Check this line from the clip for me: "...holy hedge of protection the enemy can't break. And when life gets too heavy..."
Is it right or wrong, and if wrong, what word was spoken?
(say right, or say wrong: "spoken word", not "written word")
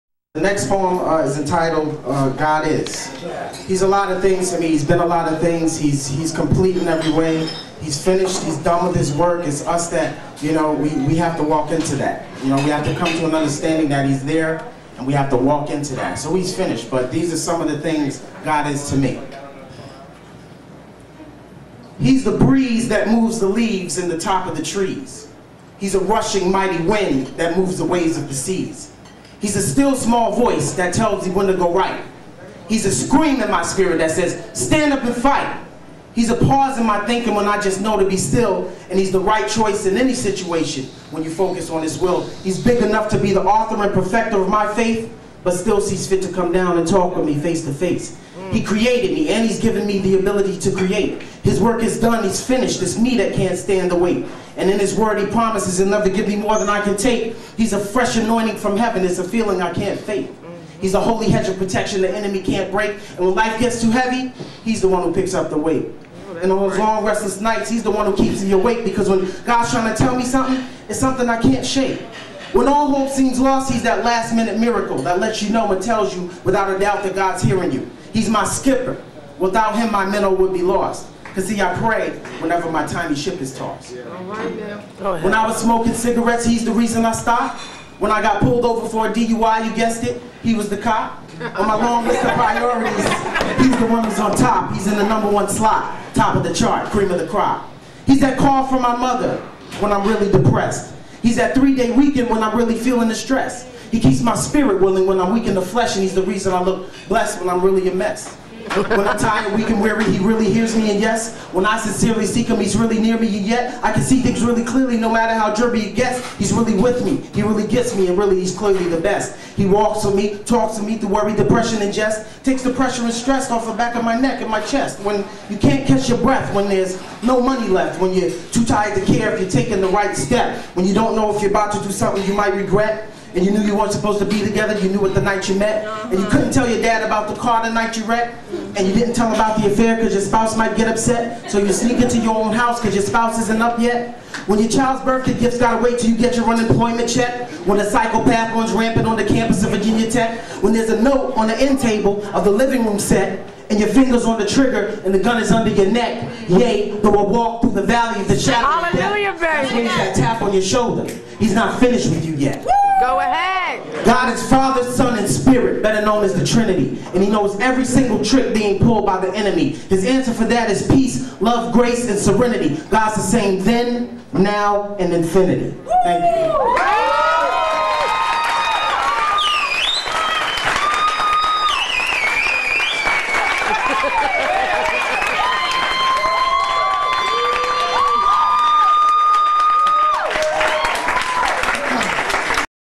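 right.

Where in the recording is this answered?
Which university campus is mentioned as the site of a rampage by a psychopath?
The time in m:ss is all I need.
2:29.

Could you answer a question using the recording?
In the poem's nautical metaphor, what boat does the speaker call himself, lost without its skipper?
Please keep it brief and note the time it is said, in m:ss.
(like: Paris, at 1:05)
minnow, at 1:20.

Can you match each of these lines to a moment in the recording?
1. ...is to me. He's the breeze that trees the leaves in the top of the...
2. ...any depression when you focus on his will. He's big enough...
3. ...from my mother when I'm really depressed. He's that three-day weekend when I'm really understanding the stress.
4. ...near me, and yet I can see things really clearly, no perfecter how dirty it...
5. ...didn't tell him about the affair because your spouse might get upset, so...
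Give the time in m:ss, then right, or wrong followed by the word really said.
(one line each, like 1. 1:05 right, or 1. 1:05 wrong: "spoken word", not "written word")
1. 0:18 wrong: "moves", not "trees"
2. 0:39 wrong: "situation", not "depression"
3. 1:38 wrong: "feeling", not "understanding"
4. 1:53 wrong: "matter", not "perfecter"
5. 2:18 right.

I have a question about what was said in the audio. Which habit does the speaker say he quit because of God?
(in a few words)
smoking cigarettes.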